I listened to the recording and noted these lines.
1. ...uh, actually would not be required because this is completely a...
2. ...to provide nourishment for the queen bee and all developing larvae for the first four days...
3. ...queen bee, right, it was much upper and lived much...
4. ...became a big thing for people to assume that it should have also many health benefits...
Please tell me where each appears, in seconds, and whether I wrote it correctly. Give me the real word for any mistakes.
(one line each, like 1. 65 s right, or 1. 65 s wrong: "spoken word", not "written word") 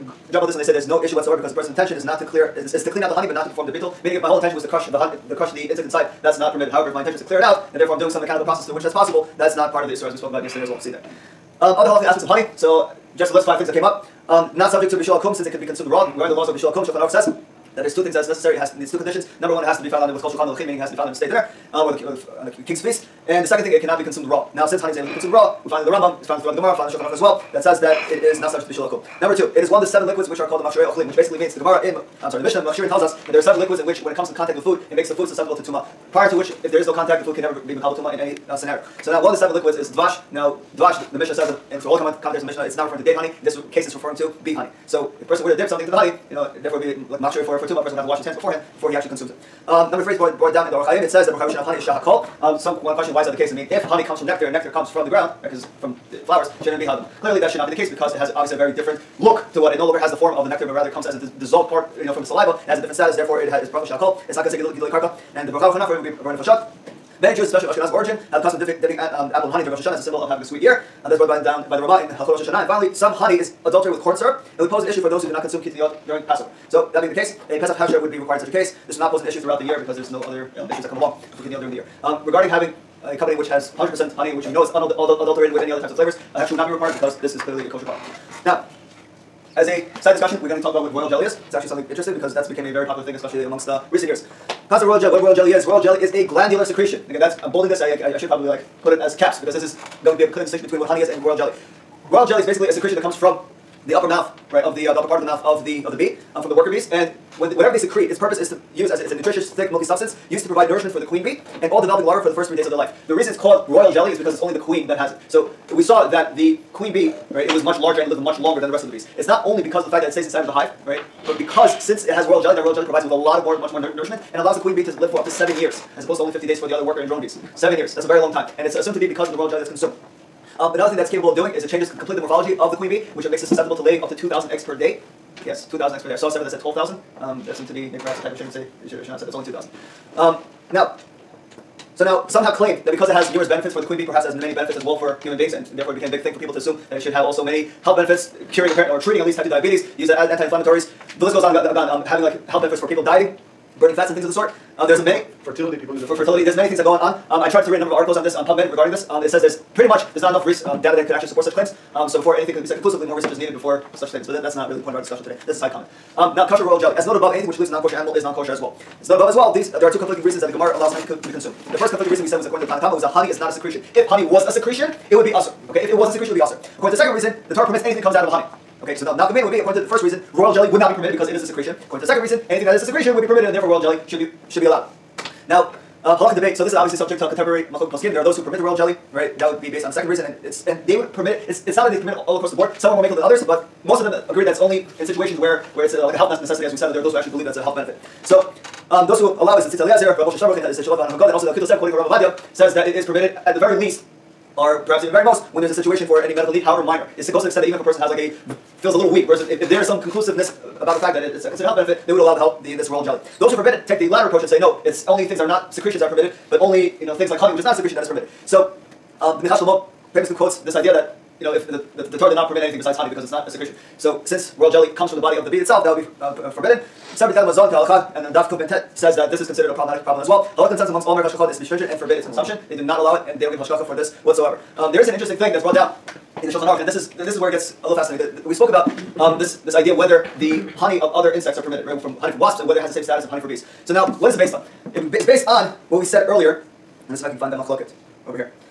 1. 86 s wrong: "clearly", not "completely"
2. 110 s wrong: "three", not "four"
3. 116 s wrong: "larger", not "upper"
4. 145 s right.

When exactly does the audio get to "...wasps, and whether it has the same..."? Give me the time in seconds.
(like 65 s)
242 s.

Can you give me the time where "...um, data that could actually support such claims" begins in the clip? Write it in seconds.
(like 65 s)
160 s.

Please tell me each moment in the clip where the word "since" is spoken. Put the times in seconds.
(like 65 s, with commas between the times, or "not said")
15 s, 24 s, 121 s, 224 s.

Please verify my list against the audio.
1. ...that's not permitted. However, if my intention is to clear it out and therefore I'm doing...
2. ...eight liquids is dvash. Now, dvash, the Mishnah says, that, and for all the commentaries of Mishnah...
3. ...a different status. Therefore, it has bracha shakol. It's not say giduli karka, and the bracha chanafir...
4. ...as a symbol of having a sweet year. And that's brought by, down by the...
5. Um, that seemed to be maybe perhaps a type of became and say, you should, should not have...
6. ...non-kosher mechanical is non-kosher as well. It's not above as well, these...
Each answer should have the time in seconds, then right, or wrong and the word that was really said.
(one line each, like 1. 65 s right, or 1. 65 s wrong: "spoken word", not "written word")
1. 6 s right
2. 39 s wrong: "seven", not "eight"
3. 62 s right
4. 69 s right
5. 137 s wrong: "shame", not "became"
6. 167 s wrong: "animal", not "mechanical".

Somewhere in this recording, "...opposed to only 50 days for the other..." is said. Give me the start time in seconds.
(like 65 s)
126 s.